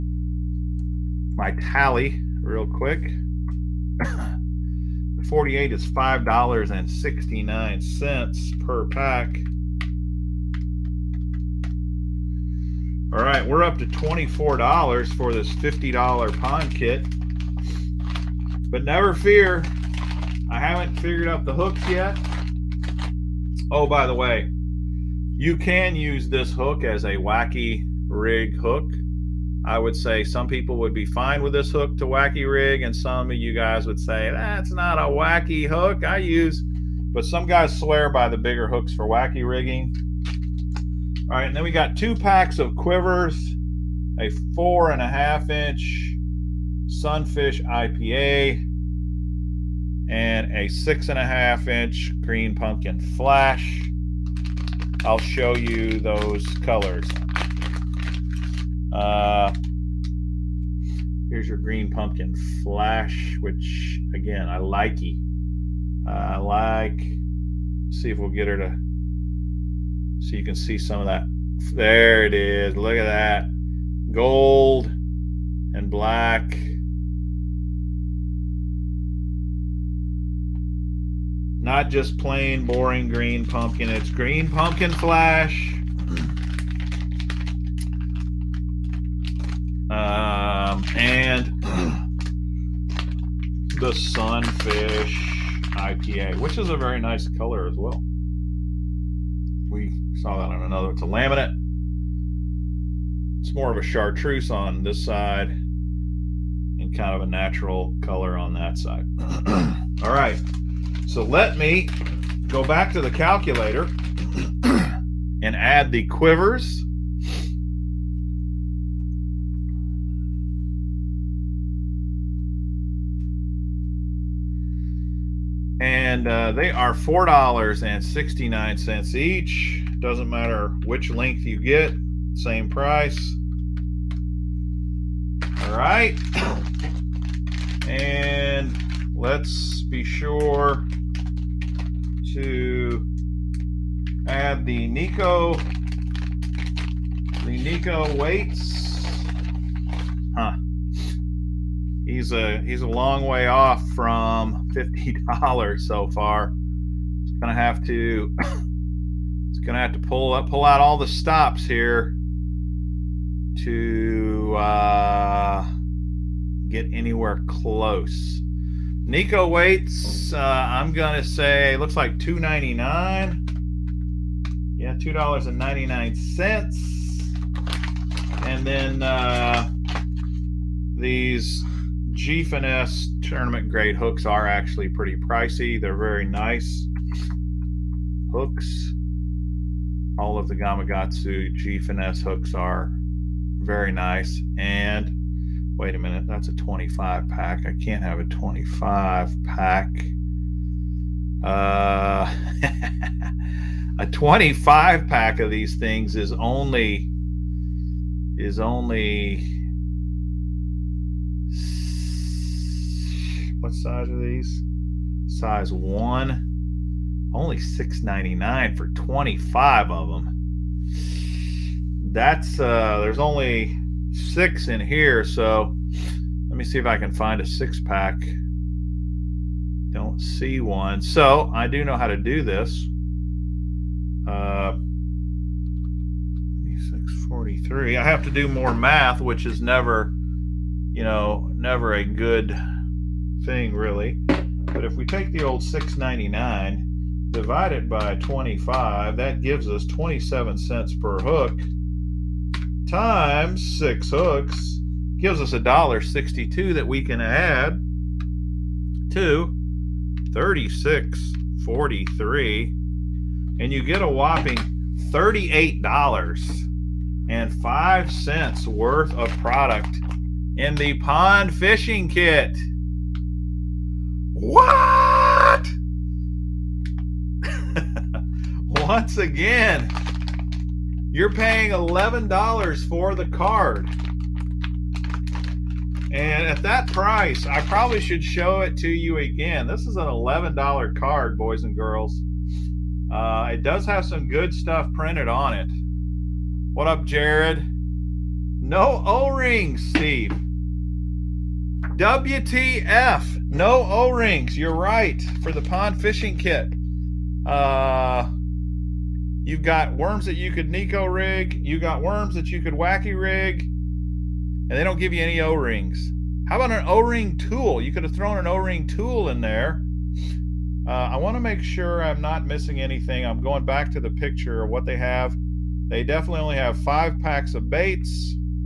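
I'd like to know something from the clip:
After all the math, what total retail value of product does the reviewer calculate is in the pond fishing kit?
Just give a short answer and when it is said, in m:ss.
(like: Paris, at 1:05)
$38.05, at 4:24.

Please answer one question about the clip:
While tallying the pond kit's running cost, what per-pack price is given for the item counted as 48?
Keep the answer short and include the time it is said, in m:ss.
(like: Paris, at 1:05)
$5.69, at 0:05.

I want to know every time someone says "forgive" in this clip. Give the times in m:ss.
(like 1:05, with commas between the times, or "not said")
not said.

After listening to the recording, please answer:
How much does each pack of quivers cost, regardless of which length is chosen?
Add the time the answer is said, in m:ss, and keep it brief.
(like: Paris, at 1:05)
$4.69, at 2:06.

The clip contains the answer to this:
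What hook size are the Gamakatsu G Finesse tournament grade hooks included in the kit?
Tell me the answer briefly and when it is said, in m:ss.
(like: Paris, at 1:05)
Size 1, at 3:35.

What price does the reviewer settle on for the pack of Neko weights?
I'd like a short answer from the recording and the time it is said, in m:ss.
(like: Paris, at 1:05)
$2.99, at 2:54.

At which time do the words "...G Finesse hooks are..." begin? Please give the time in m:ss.
3:11.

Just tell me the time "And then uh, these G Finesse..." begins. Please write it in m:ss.
2:58.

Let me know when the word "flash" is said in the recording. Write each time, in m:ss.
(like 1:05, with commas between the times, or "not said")
0:52, 1:02, 1:24.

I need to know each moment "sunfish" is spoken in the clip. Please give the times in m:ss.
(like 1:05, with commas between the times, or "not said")
0:46, 1:33.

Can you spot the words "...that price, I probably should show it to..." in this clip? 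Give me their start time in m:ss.
4:46.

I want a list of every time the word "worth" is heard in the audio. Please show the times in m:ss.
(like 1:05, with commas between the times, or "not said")
4:28.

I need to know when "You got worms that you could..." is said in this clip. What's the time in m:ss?
5:11.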